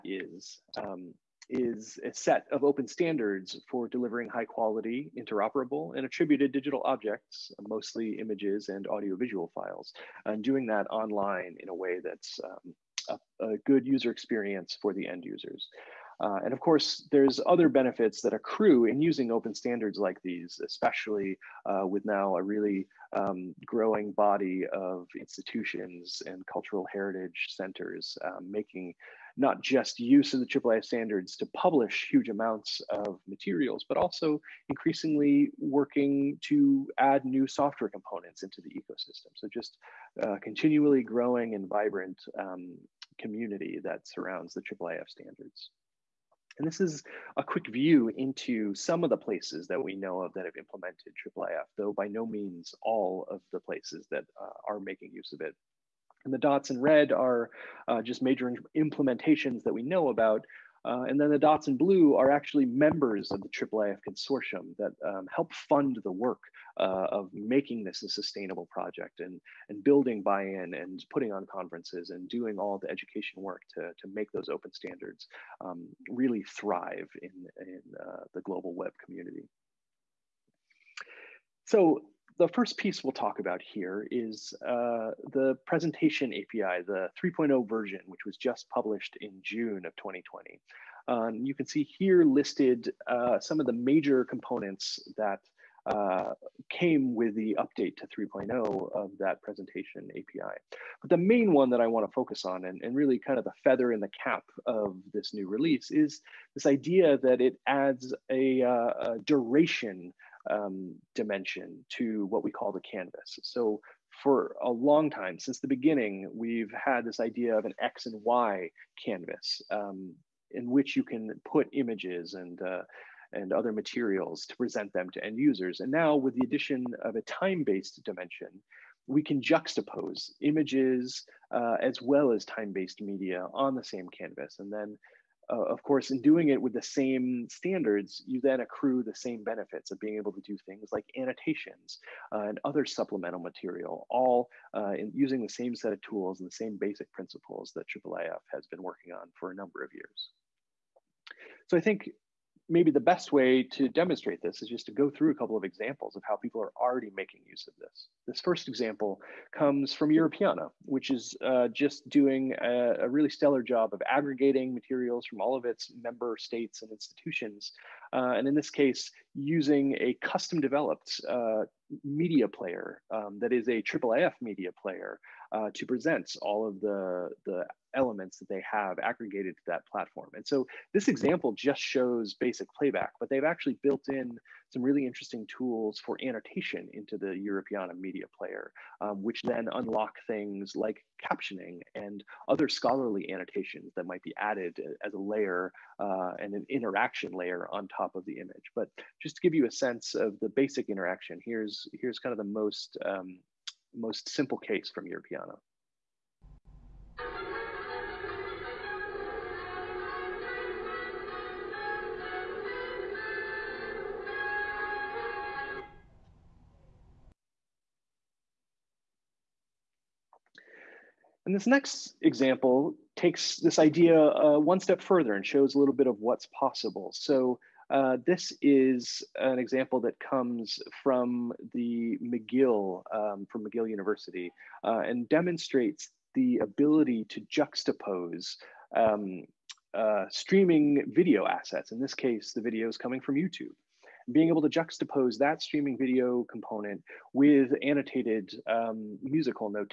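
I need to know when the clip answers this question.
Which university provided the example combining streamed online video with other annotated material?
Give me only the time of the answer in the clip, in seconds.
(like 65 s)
233 s.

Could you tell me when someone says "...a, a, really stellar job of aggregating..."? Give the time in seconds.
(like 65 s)
162 s.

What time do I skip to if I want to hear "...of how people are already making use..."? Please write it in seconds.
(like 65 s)
156 s.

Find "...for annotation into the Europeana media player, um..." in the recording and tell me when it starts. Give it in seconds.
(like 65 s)
186 s.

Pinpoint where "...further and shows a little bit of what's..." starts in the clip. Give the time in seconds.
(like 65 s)
225 s.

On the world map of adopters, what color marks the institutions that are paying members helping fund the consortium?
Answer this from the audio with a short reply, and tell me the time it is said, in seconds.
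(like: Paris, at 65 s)
Blue, at 61 s.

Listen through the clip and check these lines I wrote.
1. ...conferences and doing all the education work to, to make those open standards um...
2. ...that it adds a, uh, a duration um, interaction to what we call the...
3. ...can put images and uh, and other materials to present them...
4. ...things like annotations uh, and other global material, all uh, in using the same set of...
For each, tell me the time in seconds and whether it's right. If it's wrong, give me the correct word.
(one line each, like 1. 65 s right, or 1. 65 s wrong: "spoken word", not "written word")
1. 71 s right
2. 107 s wrong: "dimension", not "interaction"
3. 121 s right
4. 140 s wrong: "supplemental", not "global".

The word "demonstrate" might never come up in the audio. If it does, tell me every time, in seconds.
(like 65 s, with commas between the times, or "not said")
153 s, 235 s.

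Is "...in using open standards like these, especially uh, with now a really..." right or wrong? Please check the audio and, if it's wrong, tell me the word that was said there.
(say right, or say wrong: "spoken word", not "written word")
right.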